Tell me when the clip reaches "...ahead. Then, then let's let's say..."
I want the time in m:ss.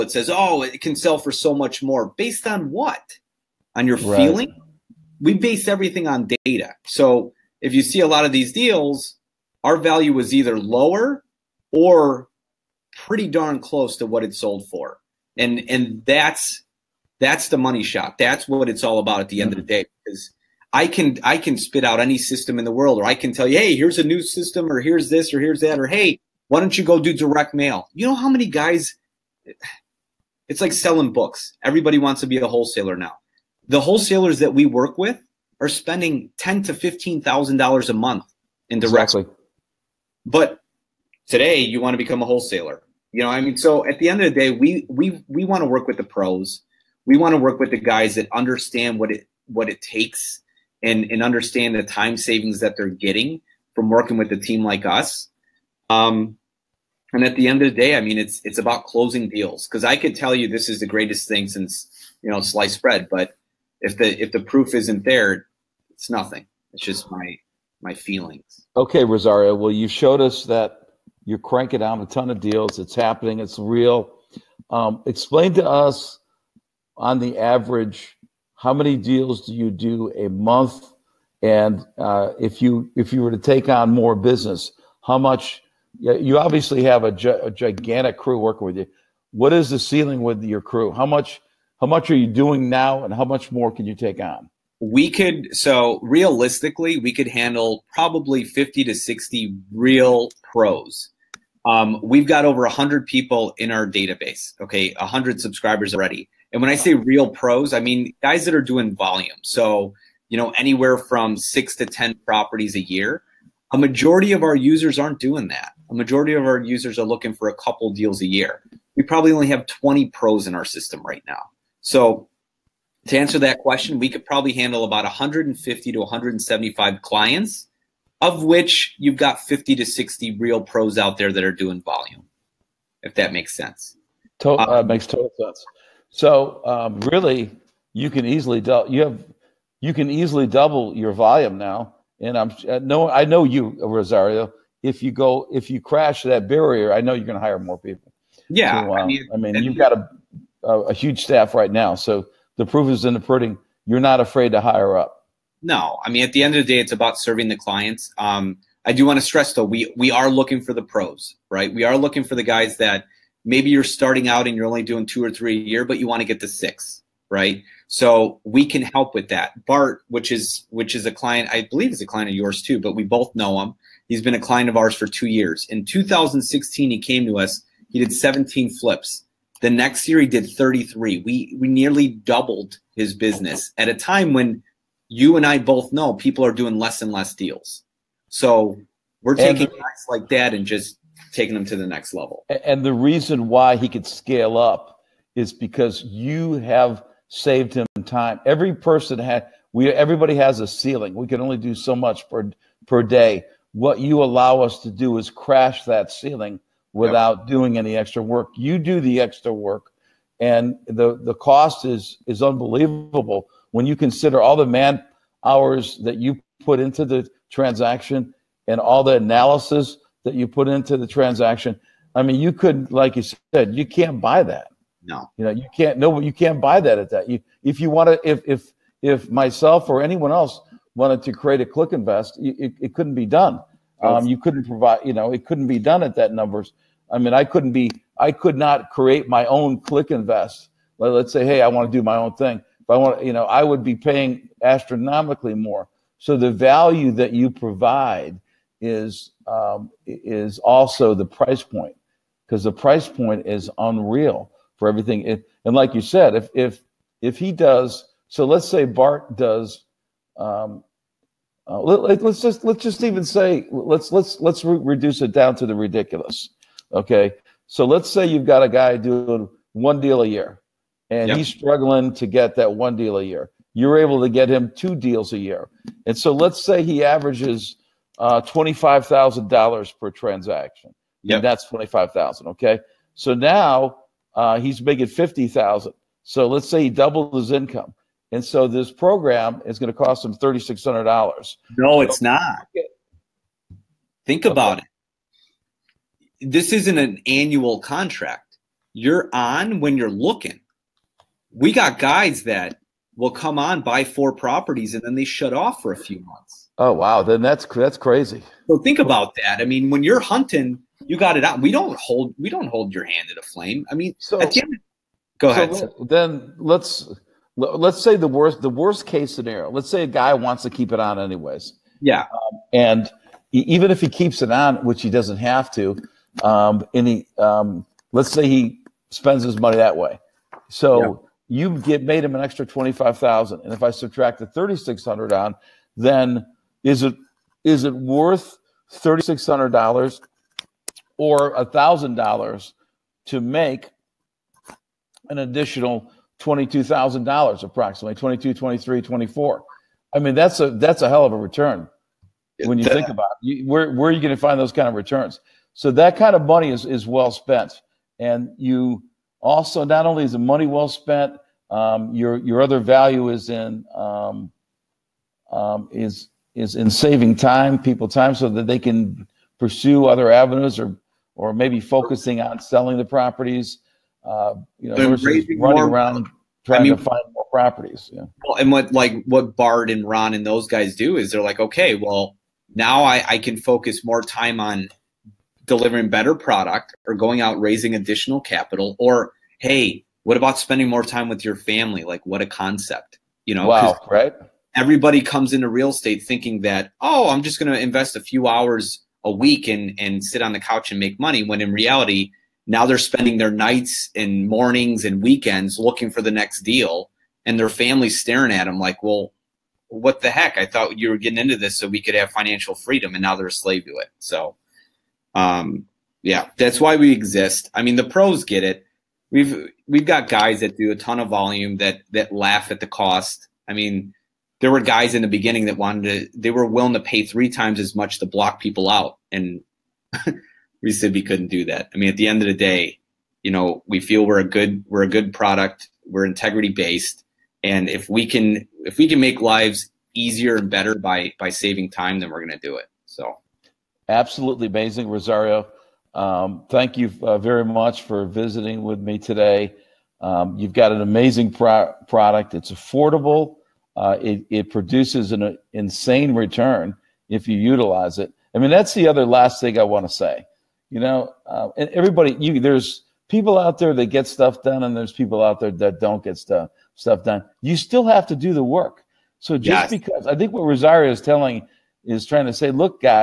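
5:15.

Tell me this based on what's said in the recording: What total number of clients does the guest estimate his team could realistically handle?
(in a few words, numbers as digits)
150 to 175.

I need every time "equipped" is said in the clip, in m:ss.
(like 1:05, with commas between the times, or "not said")
not said.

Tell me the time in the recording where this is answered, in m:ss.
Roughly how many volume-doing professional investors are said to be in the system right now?
1:59.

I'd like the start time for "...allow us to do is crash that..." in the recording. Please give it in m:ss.
3:24.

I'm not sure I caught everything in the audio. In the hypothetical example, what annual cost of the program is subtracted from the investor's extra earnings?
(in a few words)
$3,600.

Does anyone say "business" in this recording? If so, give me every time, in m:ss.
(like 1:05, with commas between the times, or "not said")
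1:24, 3:03.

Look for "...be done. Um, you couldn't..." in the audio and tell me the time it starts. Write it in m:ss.
3:53.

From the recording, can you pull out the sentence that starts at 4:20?
Um, uh, let, us just let's just even say let's let's let's re- reduce it down to the ridiculous.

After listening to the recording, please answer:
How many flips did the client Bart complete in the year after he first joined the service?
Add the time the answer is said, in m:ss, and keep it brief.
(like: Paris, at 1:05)
33, at 3:00.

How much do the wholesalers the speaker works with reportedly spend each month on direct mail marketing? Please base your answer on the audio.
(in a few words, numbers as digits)
$10,000 to $15,000.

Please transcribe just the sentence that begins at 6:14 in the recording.
Uh, you know, versus running more, around trying I mean, to find more properties.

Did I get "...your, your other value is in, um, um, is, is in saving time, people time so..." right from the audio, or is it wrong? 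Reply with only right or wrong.
right.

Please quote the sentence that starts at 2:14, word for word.
To- uh, uh, makes total sense.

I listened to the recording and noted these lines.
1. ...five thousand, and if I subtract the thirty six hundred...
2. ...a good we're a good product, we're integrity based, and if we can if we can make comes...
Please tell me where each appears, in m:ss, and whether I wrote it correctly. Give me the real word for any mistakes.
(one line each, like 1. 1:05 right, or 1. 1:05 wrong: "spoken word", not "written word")
1. 5:32 right
2. 7:14 wrong: "lives", not "comes".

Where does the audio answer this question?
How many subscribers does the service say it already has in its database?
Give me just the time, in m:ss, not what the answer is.
1:42.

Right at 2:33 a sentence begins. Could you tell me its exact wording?
You're not afraid to hire up.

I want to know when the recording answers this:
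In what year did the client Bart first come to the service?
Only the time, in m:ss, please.
2:55.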